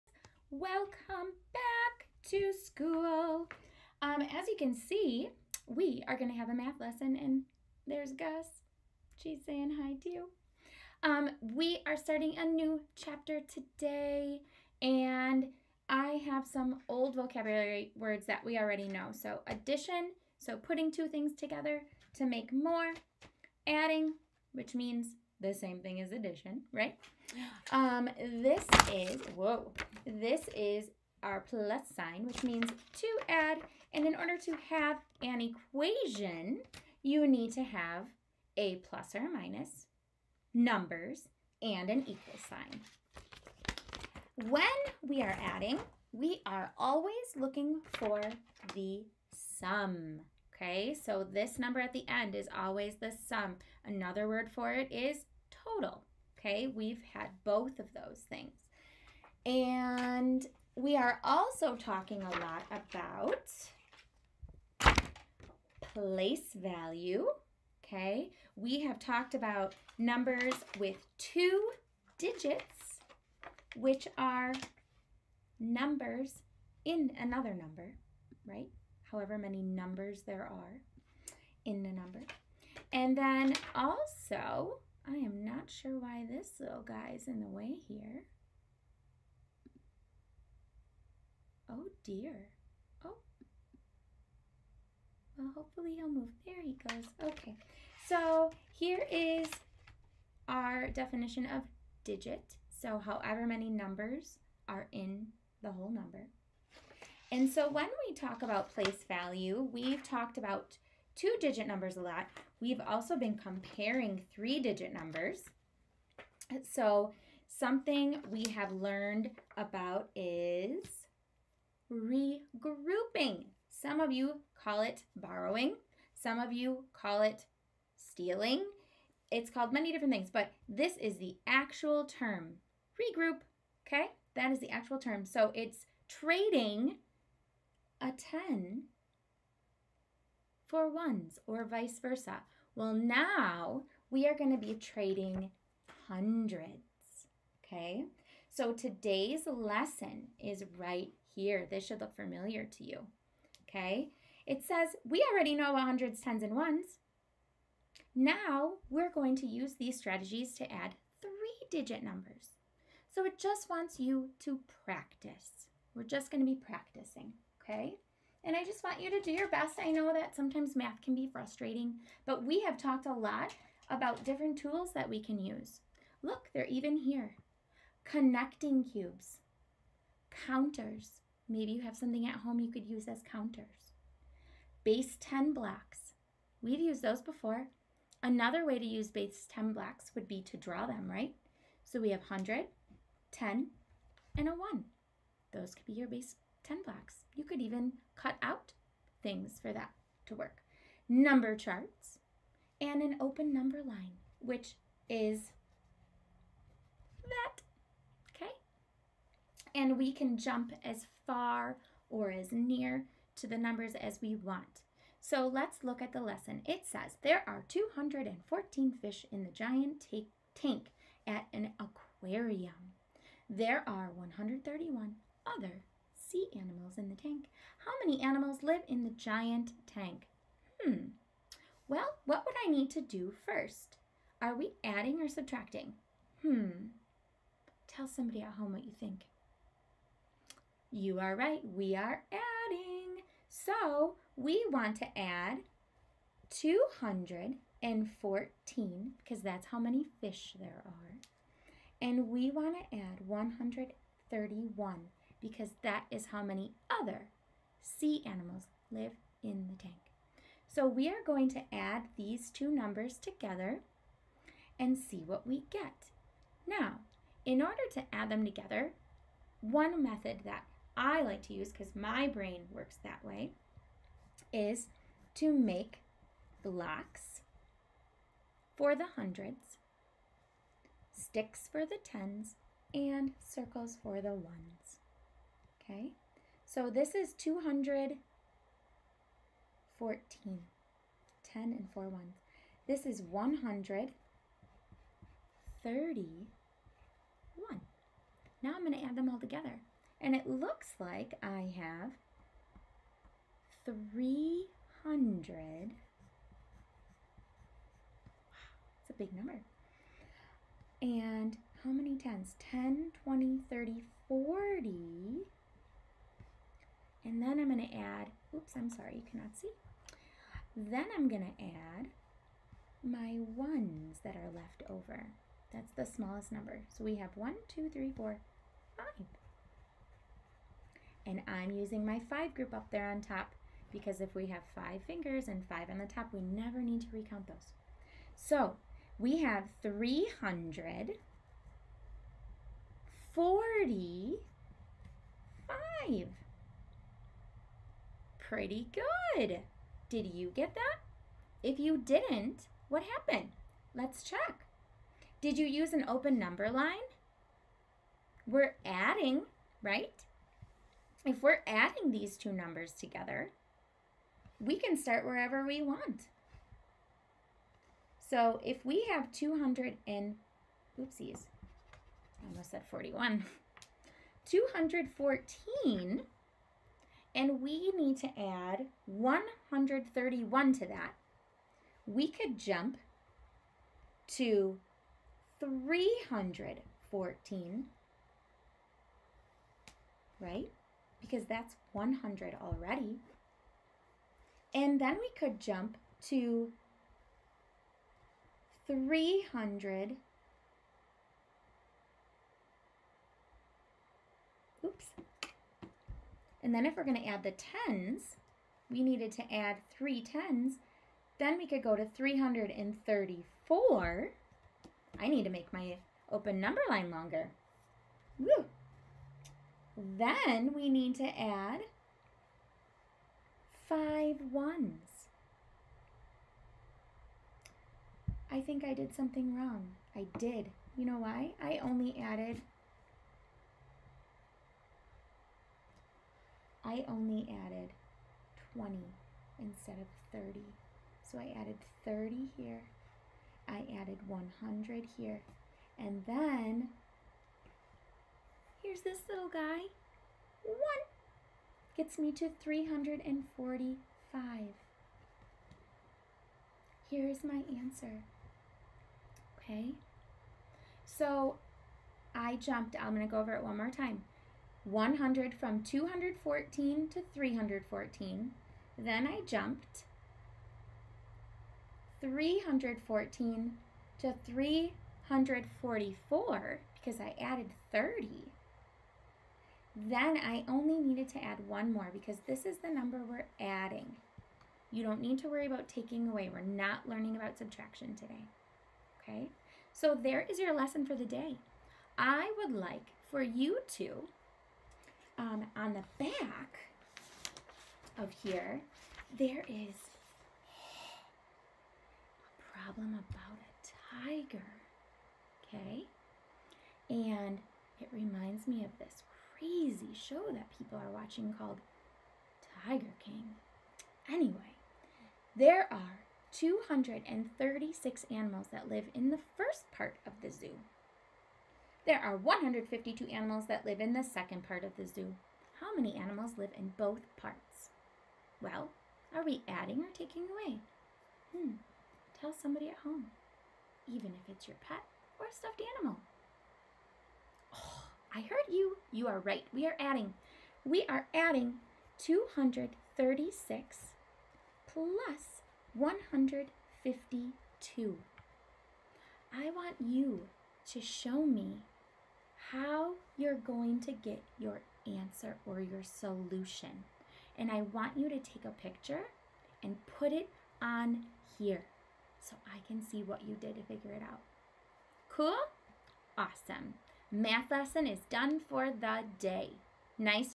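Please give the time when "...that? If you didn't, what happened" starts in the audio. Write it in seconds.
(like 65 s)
350 s.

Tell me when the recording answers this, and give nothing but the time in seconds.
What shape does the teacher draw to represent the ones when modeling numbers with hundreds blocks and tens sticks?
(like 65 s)
283 s.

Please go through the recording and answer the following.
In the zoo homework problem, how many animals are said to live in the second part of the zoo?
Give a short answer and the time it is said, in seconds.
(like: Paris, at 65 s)
152, at 522 s.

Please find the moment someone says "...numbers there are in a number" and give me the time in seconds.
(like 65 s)
79 s.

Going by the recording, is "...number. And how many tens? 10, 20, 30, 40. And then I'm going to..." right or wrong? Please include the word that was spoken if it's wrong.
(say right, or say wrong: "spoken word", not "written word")
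right.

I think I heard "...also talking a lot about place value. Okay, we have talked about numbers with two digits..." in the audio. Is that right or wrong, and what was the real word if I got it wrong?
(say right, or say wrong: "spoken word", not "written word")
right.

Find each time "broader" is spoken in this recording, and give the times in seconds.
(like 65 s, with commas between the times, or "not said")
not said.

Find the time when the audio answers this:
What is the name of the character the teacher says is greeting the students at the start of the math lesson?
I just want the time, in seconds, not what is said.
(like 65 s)
8 s.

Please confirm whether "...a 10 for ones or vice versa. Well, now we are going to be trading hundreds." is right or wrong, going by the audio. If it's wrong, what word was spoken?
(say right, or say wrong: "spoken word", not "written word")
right.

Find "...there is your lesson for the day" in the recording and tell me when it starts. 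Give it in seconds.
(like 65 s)
490 s.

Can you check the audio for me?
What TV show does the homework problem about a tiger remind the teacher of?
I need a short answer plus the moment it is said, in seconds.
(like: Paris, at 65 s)
Tiger King, at 512 s.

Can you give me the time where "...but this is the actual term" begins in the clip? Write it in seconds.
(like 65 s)
130 s.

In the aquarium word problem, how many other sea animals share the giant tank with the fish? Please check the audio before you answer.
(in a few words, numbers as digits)
131.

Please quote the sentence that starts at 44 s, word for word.
When we are adding, we are always looking for the sum.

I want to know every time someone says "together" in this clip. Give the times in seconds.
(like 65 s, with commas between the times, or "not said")
21 s, 263 s, 268 s, 299 s, 362 s.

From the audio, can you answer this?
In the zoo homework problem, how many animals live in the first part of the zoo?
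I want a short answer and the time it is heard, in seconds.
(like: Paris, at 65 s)
236, at 516 s.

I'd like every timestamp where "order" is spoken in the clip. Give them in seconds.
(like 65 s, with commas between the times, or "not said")
34 s, 267 s.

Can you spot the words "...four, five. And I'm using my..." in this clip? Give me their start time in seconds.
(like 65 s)
328 s.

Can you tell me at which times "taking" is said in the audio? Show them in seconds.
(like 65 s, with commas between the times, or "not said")
485 s, 530 s.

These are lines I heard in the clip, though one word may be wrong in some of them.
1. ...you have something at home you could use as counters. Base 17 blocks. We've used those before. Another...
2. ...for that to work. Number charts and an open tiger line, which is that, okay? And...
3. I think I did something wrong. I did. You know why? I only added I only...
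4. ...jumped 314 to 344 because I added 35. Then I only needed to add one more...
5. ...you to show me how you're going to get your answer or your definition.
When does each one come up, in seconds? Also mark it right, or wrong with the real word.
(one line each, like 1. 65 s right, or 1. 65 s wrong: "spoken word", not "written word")
1. 181 s wrong: "10", not "17"
2. 199 s wrong: "number", not "tiger"
3. 428 s right
4. 469 s wrong: "30", not "35"
5. 550 s wrong: "solution", not "definition".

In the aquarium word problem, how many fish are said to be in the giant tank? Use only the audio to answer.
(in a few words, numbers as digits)
214.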